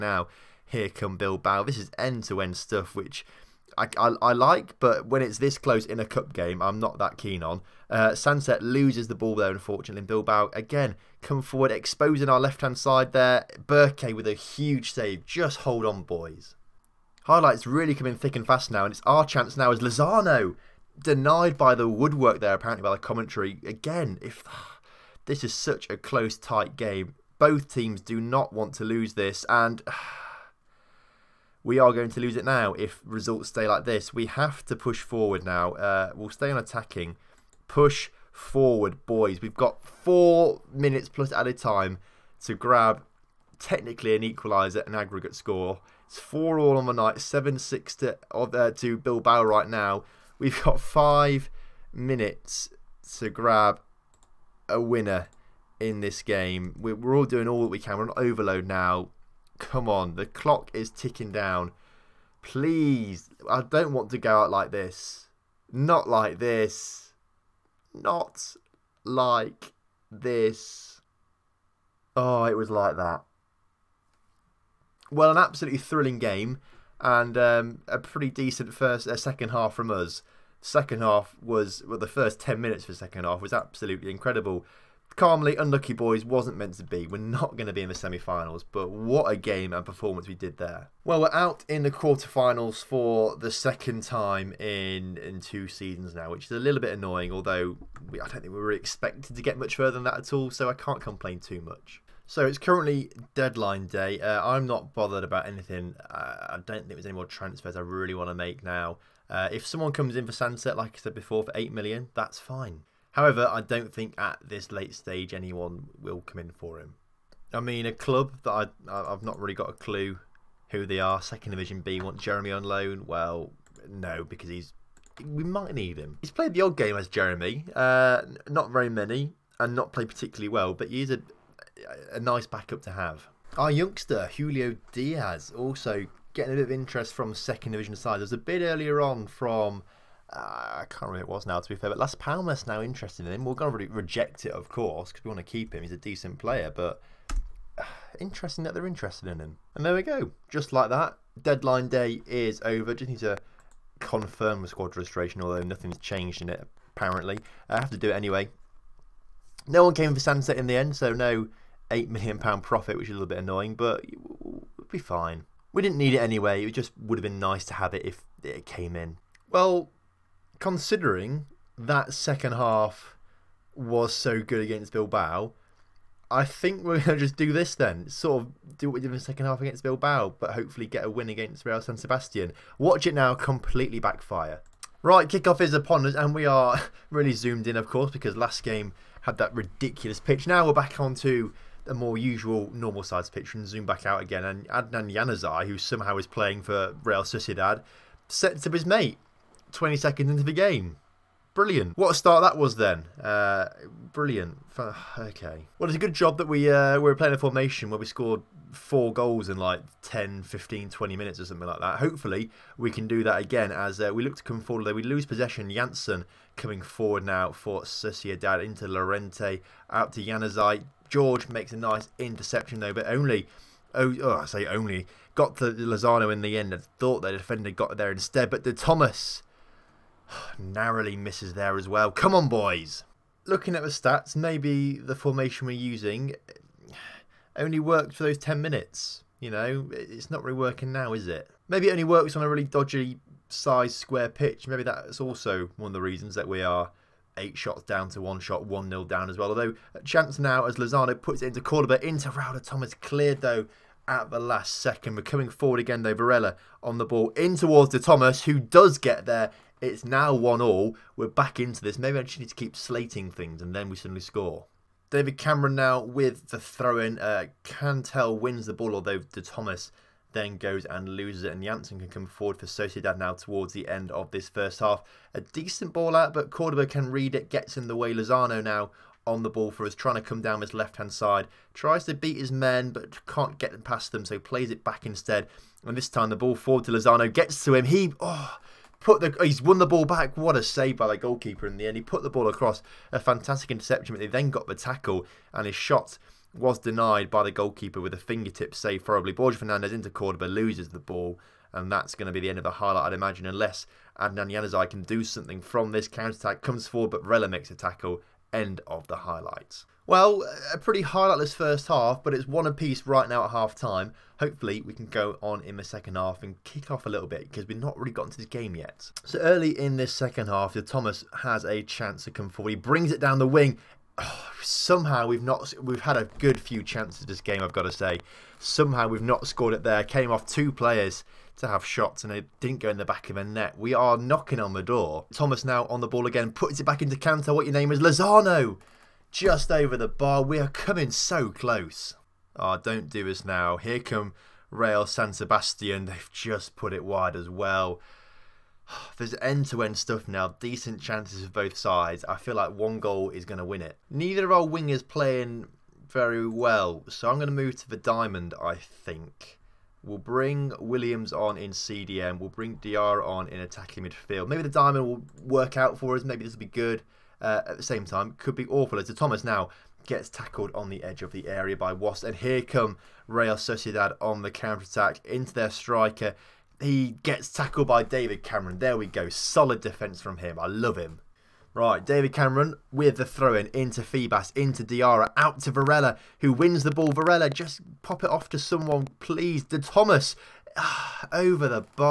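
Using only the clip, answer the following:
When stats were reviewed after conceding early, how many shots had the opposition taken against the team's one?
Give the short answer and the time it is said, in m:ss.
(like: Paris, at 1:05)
8, at 4:07.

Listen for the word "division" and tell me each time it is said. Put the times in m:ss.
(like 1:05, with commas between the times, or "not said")
2:01, 2:17.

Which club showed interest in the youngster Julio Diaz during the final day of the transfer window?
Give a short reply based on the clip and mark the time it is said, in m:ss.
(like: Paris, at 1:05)
Las Palmas, at 2:21.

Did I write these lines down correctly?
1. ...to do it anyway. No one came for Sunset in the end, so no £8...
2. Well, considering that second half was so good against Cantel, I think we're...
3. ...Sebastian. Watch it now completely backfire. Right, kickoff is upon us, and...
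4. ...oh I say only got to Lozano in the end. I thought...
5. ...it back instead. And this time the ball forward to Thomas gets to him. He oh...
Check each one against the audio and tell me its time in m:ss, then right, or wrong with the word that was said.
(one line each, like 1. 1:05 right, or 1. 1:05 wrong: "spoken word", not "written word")
1. 2:37 right
2. 2:49 wrong: "Bilbao", not "Cantel"
3. 3:01 right
4. 3:44 right
5. 4:44 wrong: "Lozano", not "Thomas".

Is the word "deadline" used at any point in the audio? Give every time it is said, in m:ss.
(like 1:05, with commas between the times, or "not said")
1:43, 2:31.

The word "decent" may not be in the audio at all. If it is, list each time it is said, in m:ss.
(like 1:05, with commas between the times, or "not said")
1:18, 2:25, 4:35, 5:50.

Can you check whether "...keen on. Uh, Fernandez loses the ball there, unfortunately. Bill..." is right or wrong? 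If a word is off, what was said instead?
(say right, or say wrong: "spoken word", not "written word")
wrong: "Sunset", not "Fernandez".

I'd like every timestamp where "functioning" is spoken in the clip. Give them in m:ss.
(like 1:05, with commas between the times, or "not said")
not said.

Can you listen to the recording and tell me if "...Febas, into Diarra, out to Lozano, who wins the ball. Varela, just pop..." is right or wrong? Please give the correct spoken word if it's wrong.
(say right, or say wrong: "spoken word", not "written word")
wrong: "Varela", not "Lozano".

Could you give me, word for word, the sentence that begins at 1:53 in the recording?
However, I don't think at this late stage anyone will come in for him.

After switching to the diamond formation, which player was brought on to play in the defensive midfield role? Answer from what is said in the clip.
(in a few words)
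Williams.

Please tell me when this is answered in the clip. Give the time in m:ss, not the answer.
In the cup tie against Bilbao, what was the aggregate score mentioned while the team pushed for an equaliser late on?
0:47.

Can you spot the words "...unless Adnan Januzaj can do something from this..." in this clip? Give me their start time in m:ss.
5:03.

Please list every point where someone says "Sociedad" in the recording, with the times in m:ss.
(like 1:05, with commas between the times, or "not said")
3:17, 3:37, 4:32, 6:13.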